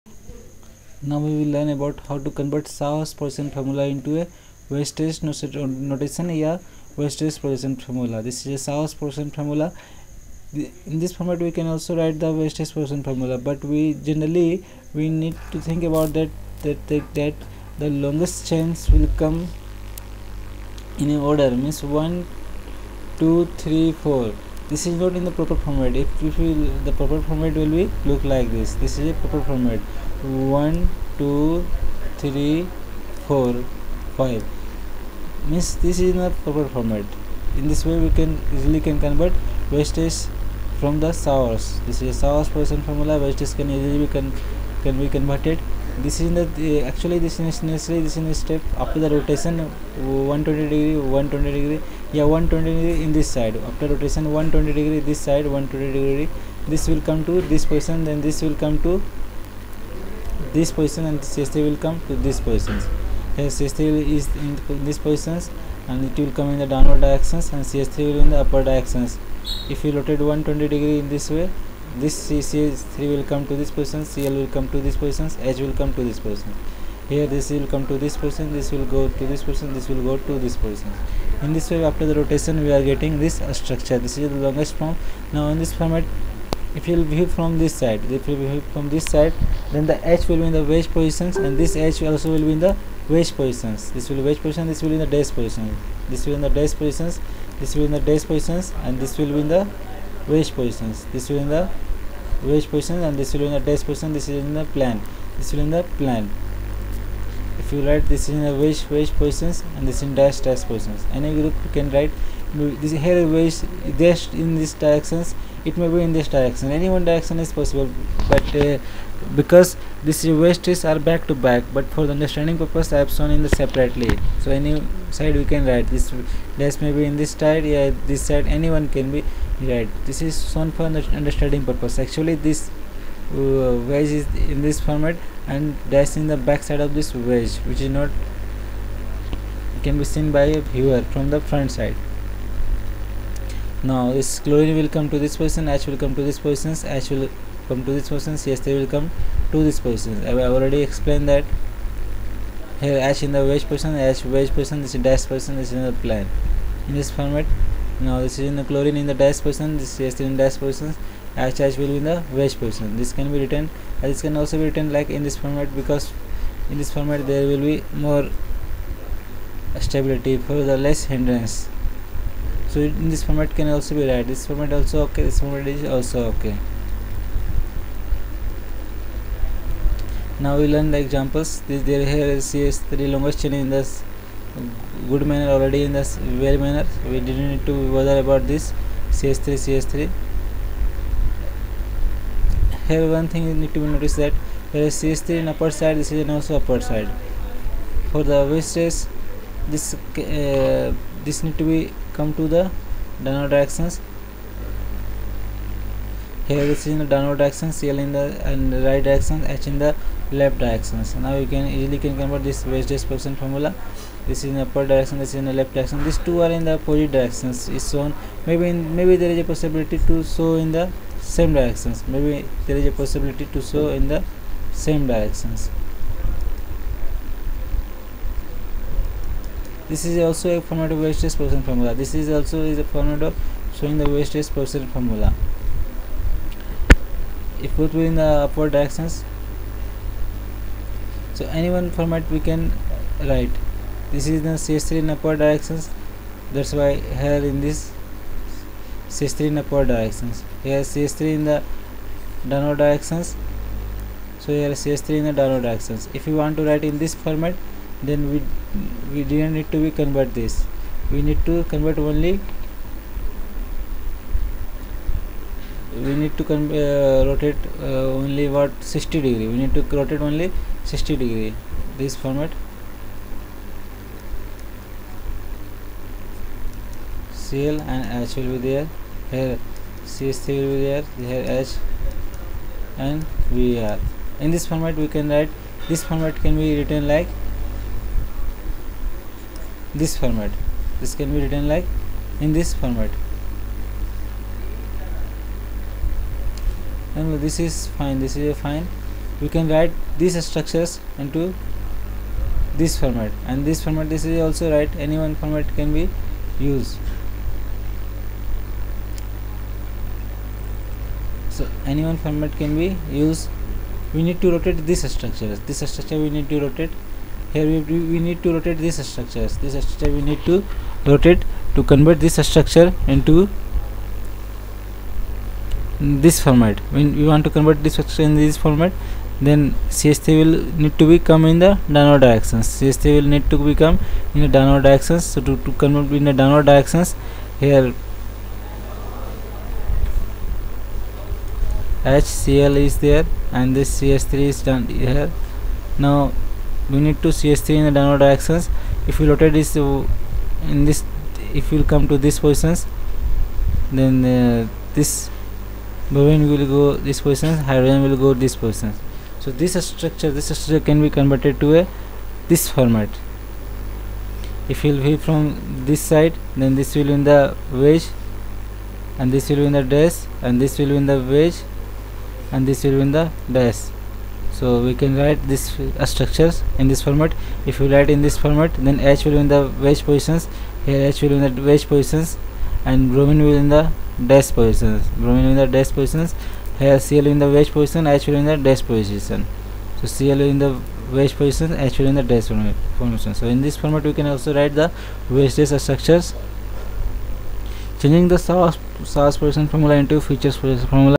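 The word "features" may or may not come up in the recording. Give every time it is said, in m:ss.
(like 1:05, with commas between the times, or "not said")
6:40.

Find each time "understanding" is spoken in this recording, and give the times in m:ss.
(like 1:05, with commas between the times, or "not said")
2:02, 2:11.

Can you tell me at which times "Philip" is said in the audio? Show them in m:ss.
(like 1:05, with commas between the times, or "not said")
not said.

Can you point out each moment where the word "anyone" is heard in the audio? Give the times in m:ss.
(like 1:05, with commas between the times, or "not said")
2:08.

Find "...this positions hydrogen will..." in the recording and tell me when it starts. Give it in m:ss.
5:57.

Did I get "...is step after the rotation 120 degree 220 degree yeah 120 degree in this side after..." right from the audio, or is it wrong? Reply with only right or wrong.
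wrong.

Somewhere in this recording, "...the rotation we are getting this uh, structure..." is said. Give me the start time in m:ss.
1:22.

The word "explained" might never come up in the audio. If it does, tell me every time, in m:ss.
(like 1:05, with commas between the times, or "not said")
2:30.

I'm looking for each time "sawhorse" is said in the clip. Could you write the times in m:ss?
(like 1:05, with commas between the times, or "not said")
0:02, 0:08.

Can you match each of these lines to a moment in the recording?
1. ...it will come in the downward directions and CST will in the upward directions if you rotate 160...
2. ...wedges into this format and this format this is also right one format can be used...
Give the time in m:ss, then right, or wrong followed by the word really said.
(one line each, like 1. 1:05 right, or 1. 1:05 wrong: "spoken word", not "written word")
1. 1:06 wrong: "120", not "160"
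2. 5:00 wrong: "structures", not "wedges".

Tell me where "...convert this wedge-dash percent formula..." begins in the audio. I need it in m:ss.
3:32.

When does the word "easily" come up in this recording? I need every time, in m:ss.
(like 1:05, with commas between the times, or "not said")
0:38, 0:43, 3:31.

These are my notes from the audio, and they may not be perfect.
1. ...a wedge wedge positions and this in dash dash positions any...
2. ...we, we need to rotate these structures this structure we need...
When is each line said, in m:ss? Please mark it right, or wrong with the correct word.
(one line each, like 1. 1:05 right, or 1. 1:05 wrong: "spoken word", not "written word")
1. 1:48 right
2. 5:17 right.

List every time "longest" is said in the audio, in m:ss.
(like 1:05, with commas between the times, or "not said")
0:17, 1:24, 3:03.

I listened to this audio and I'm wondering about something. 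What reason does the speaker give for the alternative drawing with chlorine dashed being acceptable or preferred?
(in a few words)
less hindrance.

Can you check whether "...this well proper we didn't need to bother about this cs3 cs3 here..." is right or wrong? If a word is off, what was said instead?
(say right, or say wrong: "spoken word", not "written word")
wrong: "manner", not "proper".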